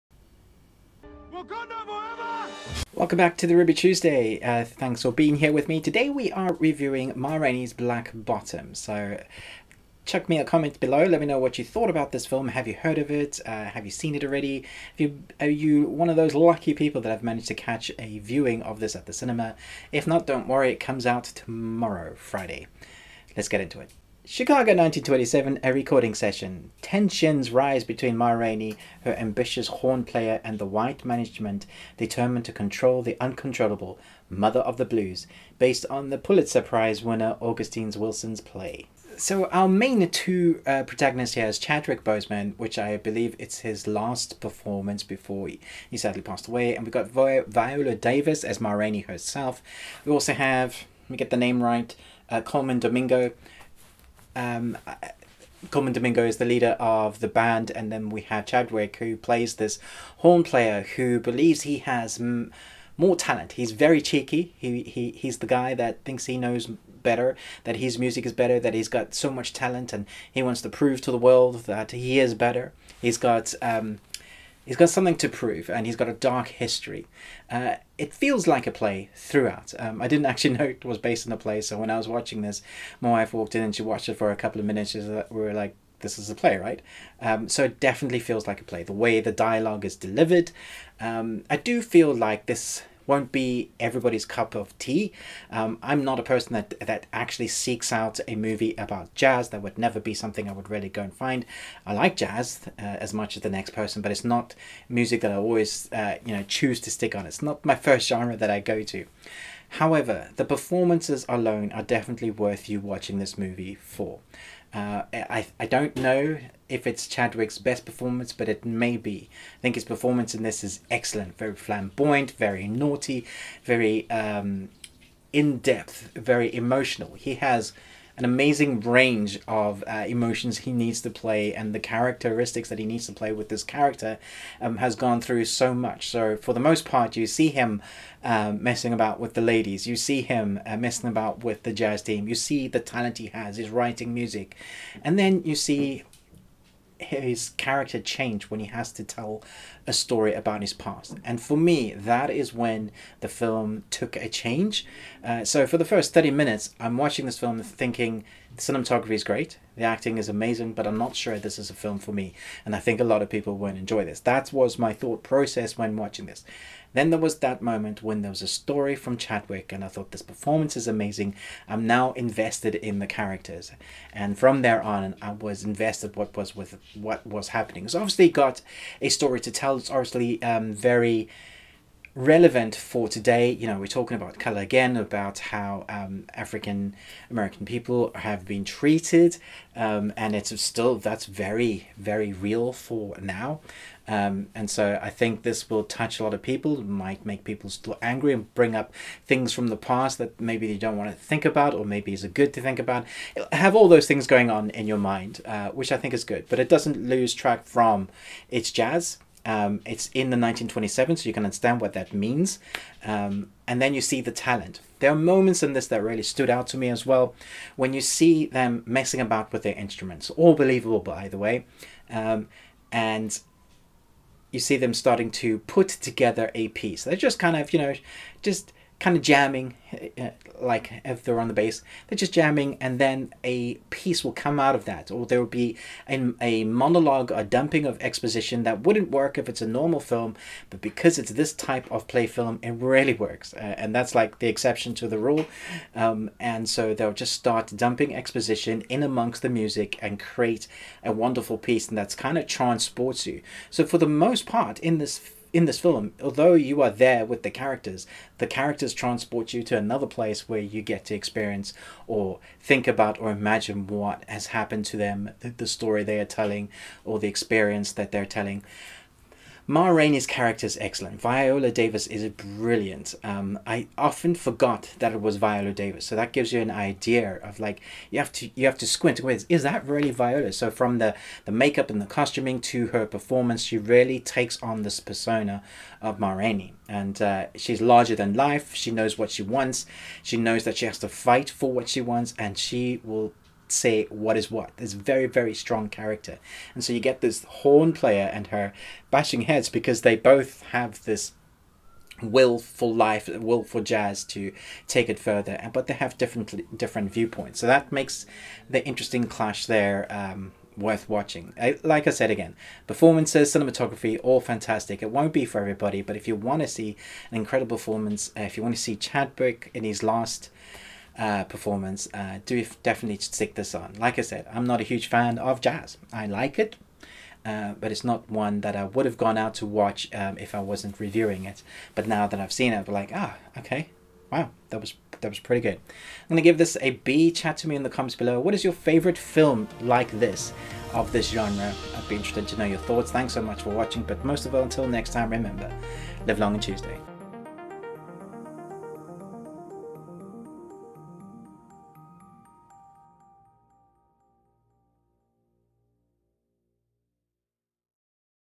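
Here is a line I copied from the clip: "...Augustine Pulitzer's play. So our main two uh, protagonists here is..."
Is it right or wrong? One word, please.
wrong.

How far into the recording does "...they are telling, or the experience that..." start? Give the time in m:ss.
4:26.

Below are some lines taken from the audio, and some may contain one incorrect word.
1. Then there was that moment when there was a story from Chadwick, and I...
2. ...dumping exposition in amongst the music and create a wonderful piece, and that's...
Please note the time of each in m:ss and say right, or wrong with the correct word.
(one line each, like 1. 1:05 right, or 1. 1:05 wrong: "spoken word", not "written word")
1. 2:46 right
2. 4:07 right.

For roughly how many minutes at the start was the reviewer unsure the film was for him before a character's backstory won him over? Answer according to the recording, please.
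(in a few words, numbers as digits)
30.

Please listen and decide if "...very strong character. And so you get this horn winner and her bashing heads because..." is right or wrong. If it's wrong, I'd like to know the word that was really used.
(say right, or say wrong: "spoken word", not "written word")
wrong: "player", not "winner".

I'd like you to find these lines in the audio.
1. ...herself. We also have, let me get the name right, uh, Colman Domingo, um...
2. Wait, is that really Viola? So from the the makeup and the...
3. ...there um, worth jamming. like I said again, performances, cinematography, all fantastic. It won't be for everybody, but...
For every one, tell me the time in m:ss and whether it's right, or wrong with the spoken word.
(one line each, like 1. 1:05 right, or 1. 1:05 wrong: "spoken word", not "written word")
1. 0:49 right
2. 4:39 right
3. 5:09 wrong: "watching", not "jamming".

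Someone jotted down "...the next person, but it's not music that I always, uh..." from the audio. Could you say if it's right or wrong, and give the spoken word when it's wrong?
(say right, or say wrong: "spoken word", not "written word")
right.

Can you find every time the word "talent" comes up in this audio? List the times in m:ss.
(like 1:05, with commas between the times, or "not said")
1:03, 1:09, 2:22, 3:34.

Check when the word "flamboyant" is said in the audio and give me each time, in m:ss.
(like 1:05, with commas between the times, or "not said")
2:01.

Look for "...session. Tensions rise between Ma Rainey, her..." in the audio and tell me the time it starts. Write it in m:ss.
0:26.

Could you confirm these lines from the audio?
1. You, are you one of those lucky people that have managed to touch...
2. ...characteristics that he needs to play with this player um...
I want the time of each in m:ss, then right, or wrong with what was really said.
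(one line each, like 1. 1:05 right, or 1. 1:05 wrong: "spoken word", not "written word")
1. 0:14 wrong: "catch", not "touch"
2. 2:11 wrong: "character", not "player".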